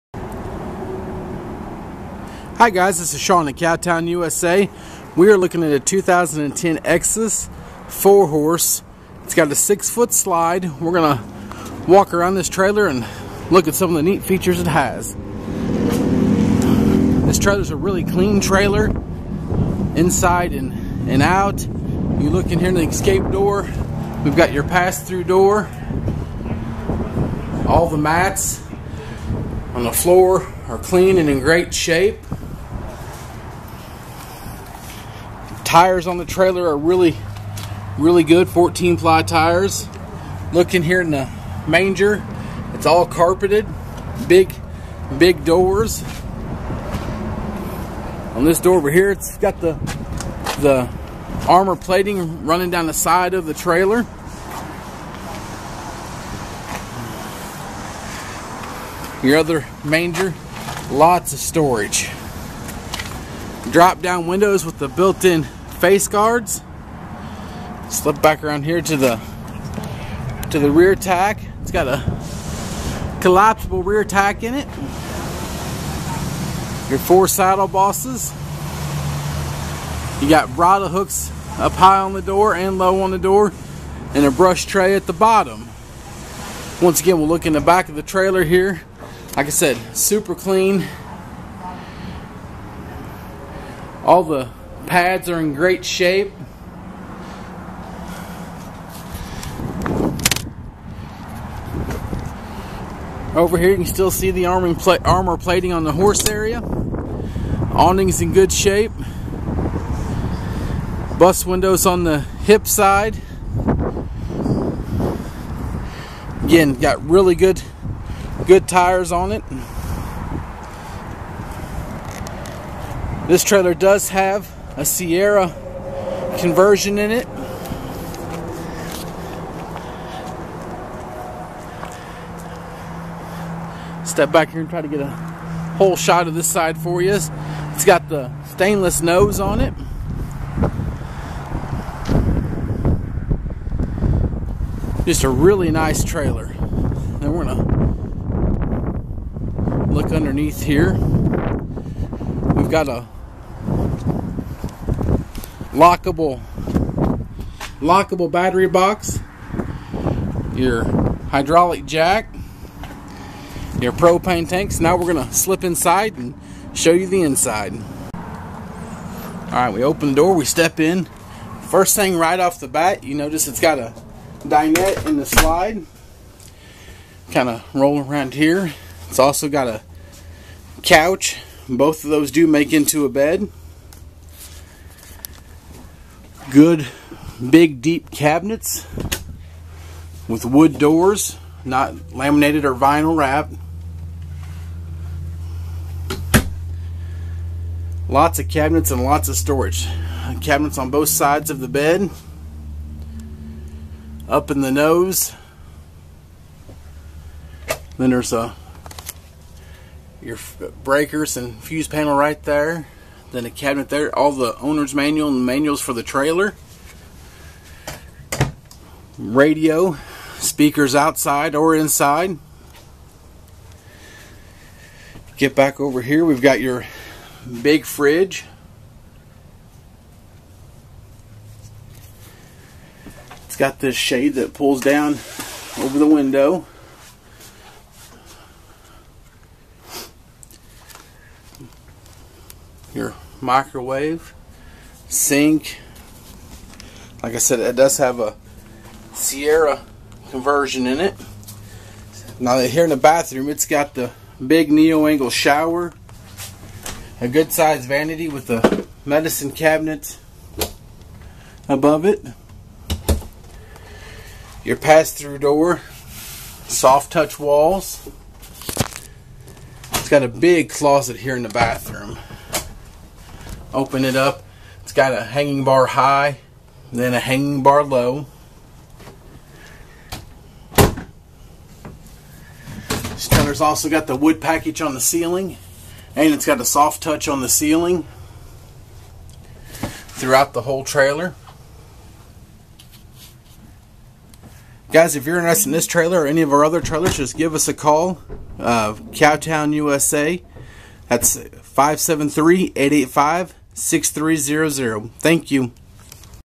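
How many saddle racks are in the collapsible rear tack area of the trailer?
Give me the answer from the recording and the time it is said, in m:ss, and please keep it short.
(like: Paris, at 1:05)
4, at 1:16.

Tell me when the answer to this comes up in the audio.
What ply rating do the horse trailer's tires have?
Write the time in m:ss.
0:38.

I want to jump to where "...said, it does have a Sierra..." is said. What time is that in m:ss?
4:07.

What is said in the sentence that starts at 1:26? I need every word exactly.
Once again, we'll look in the back of the trailer here.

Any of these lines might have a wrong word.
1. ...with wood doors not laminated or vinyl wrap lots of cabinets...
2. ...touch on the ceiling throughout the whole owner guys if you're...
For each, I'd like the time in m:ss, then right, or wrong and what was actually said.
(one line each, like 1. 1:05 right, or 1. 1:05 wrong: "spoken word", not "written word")
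1. 3:10 right
2. 4:47 wrong: "trailer", not "owner".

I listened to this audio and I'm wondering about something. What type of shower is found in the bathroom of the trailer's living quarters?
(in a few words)
neo-angle shower.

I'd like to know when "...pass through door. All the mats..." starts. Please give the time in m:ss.
0:24.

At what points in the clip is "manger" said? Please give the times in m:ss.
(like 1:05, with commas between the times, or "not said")
0:41, 0:59.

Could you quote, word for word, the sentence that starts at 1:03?
Drop down windows with the built-in face guards.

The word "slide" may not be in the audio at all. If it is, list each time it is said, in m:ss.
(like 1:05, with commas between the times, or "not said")
0:10, 2:55.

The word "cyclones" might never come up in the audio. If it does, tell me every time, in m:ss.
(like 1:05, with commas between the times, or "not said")
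not said.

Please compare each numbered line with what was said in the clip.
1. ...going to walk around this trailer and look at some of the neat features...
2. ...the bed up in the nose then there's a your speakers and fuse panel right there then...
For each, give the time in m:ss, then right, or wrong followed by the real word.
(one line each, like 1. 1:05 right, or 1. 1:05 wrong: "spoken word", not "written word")
1. 0:10 right
2. 3:21 wrong: "breakers", not "speakers".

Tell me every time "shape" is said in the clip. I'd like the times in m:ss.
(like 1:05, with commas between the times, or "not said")
0:31, 1:35, 1:48.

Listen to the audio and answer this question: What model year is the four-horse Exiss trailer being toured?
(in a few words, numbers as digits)
2010.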